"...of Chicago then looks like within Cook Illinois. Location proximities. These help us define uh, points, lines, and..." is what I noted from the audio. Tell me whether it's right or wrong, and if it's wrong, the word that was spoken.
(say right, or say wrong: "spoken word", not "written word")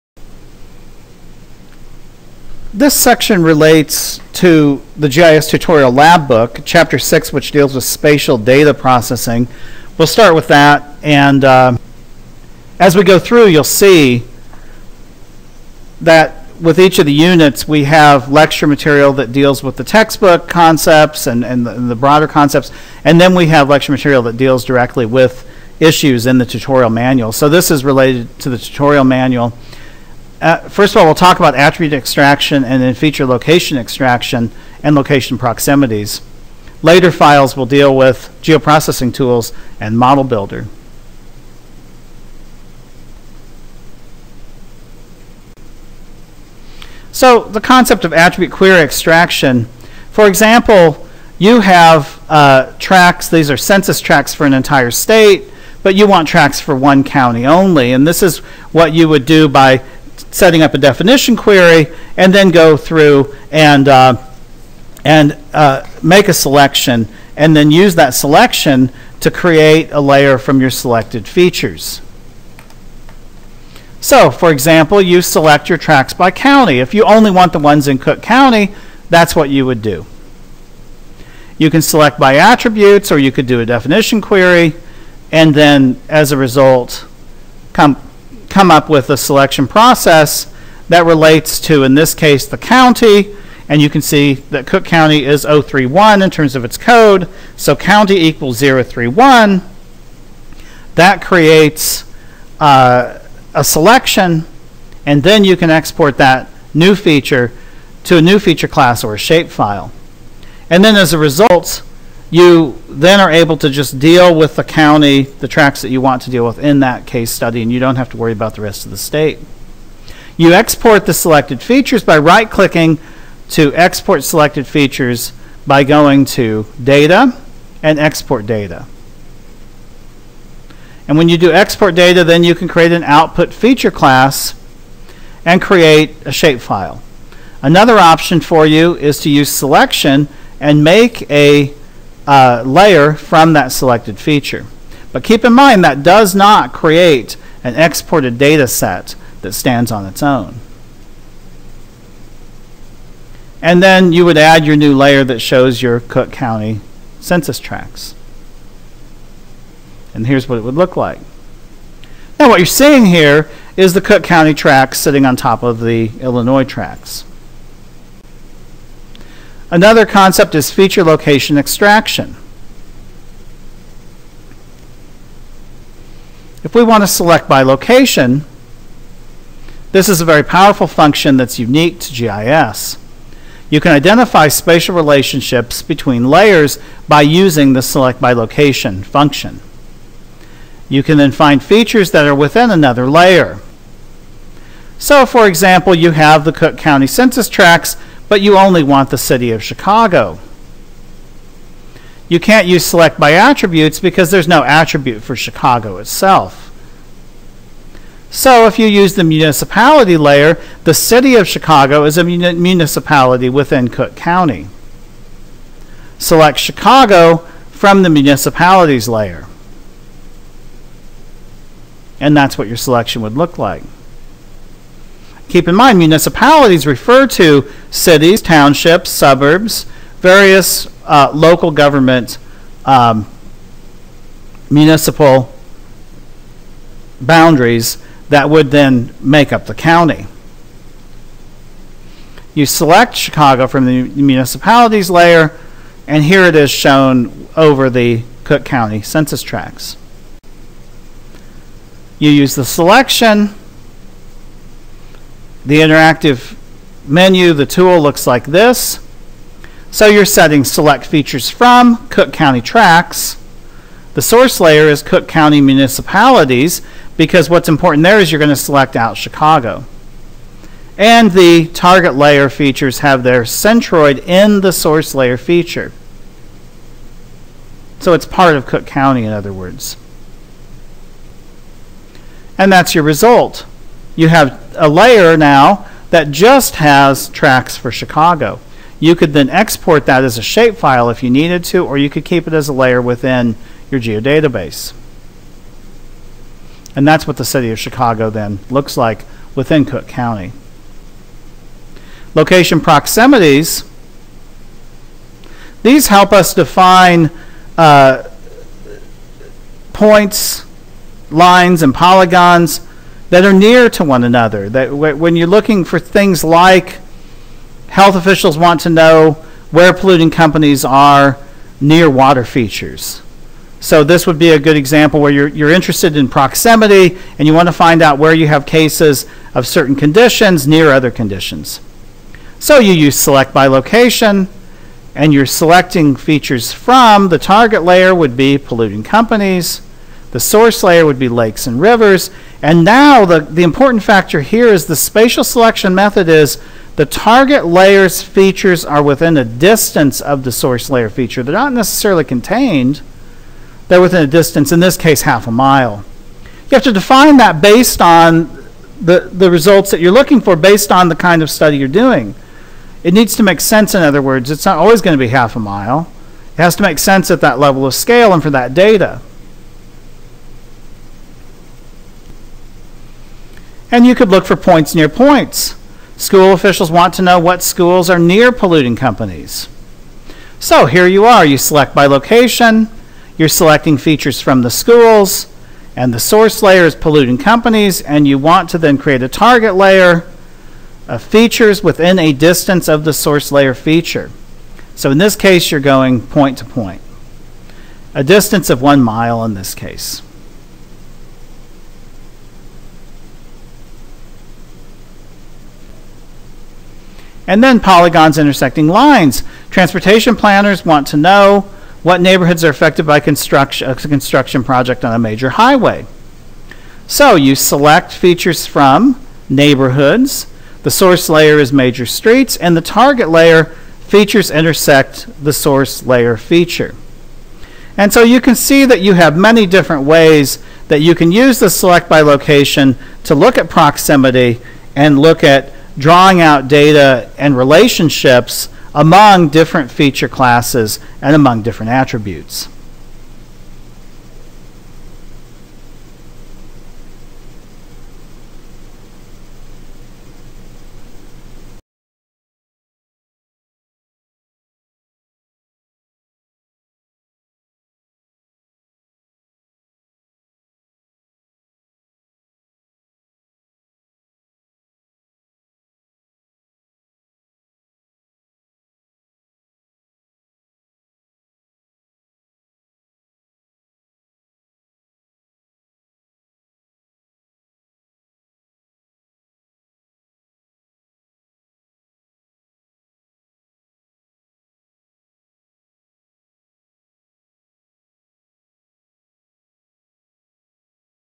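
wrong: "County", not "Illinois".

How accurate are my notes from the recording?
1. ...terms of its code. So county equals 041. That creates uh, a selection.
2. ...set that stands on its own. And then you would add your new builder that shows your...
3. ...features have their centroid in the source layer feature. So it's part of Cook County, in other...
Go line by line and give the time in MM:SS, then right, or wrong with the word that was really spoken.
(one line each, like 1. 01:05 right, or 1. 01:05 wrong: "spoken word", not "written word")
1. 01:36 wrong: "031", not "041"
2. 02:28 wrong: "layer", not "builder"
3. 04:32 right.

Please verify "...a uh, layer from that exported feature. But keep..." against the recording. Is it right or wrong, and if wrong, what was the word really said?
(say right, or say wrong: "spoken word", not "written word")
wrong: "selected", not "exported".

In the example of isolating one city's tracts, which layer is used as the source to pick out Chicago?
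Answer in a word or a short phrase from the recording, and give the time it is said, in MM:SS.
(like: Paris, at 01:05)
Cook County Municipalities, at 04:25.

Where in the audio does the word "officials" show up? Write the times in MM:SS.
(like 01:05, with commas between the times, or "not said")
05:18, 06:16.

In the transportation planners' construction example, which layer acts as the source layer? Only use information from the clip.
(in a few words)
major streets.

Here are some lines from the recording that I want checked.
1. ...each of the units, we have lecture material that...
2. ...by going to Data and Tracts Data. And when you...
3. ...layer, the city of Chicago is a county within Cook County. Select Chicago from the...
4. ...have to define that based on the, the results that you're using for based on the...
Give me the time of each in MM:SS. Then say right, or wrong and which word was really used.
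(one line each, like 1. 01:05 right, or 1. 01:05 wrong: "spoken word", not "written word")
1. 00:16 right
2. 02:05 wrong: "Export", not "Tracts"
3. 03:30 wrong: "municipality", not "county"
4. 05:56 wrong: "looking", not "using".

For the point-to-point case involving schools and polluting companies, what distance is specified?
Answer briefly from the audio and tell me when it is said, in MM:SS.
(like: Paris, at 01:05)
1 mile, at 06:38.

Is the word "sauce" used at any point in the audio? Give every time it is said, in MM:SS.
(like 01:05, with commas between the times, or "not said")
not said.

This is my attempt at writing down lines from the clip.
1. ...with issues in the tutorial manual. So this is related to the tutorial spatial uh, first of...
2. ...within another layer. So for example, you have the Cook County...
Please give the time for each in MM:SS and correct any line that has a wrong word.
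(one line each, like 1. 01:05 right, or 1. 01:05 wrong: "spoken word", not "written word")
1. 00:25 wrong: "manual", not "spatial"
2. 03:12 right.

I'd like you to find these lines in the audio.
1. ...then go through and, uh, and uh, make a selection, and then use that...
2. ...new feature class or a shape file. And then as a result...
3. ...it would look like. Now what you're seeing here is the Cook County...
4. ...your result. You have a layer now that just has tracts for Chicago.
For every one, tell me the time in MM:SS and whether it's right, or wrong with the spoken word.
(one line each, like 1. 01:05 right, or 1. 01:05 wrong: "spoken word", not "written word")
1. 01:02 right
2. 01:48 right
3. 02:40 right
4. 04:42 right.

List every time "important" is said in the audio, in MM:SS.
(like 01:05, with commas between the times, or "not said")
04:27, 05:43.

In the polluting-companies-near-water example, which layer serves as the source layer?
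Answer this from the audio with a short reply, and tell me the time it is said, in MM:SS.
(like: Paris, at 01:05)
lakes and rivers, at 05:41.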